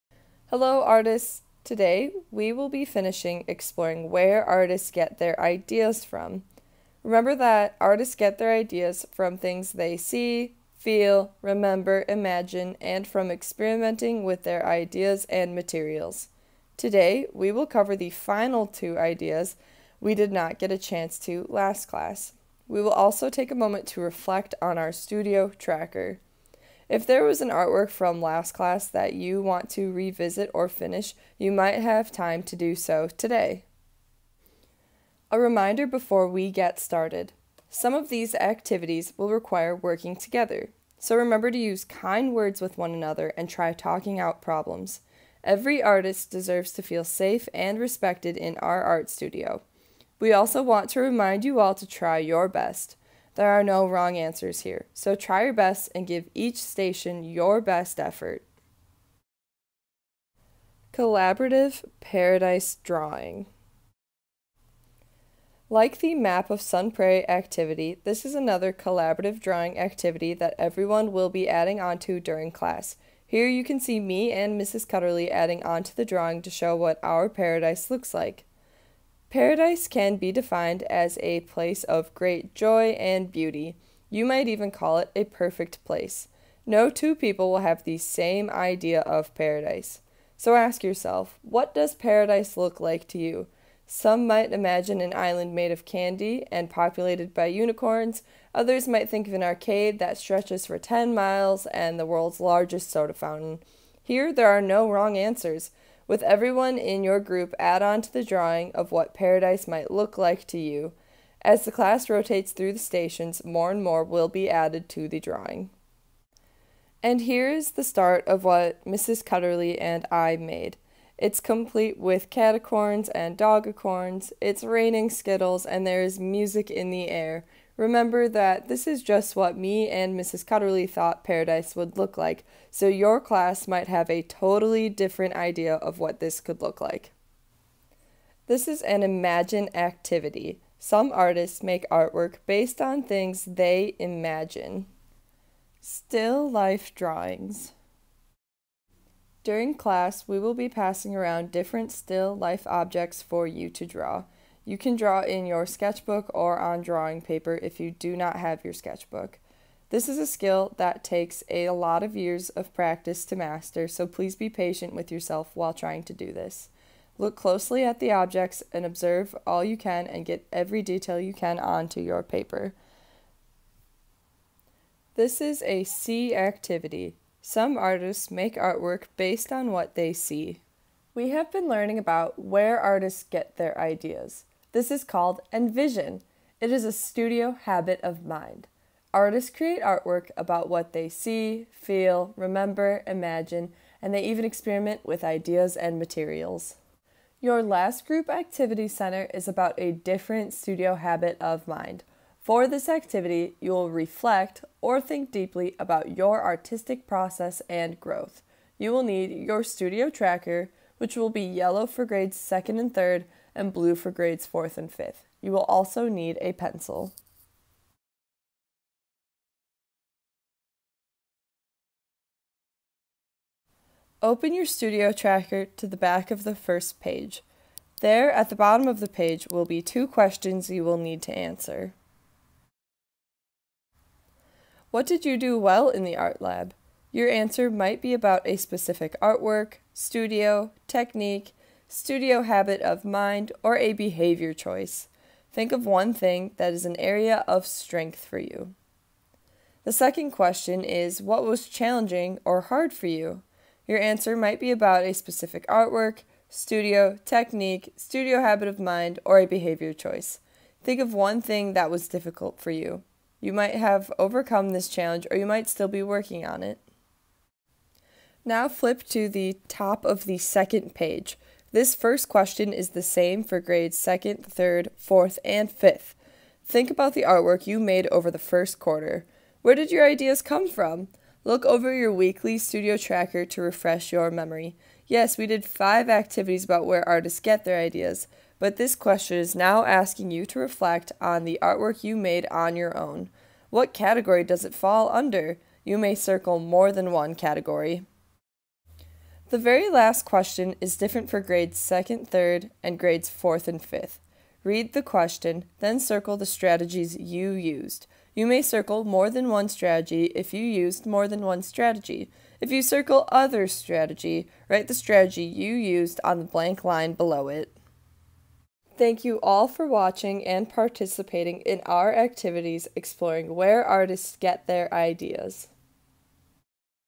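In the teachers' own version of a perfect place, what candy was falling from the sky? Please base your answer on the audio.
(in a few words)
Skittles.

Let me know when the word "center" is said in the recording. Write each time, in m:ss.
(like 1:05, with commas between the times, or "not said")
3:18.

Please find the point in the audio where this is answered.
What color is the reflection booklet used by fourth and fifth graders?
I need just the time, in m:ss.
3:33.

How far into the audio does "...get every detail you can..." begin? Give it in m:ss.
2:50.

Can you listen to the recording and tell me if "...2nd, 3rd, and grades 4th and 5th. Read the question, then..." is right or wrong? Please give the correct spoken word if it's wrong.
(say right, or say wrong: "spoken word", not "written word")
right.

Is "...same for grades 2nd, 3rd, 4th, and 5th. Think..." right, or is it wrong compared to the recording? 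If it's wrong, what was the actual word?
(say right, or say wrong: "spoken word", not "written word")
right.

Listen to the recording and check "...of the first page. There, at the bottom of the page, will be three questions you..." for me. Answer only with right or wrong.
wrong.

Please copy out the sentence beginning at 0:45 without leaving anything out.
Every artist deserves to feel safe and respected in our art studio.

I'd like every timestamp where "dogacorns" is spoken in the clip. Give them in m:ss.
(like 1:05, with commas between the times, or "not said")
2:03.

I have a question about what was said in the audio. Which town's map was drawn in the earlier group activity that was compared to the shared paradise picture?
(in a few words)
Sun Prairie.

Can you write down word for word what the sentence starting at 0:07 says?
Remember that artists get their ideas from things they see, feel, remember, imagine, and from experimenting with their ideas and materials.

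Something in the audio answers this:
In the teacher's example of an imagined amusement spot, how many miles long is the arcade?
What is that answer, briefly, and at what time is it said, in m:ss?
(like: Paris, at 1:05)
10, at 1:40.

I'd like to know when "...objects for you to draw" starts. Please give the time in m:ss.
2:32.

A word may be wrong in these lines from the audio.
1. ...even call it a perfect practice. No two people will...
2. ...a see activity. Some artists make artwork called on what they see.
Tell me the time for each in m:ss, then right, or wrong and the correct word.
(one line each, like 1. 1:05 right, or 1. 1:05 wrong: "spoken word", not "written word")
1. 1:24 wrong: "place", not "practice"
2. 2:55 wrong: "based", not "called".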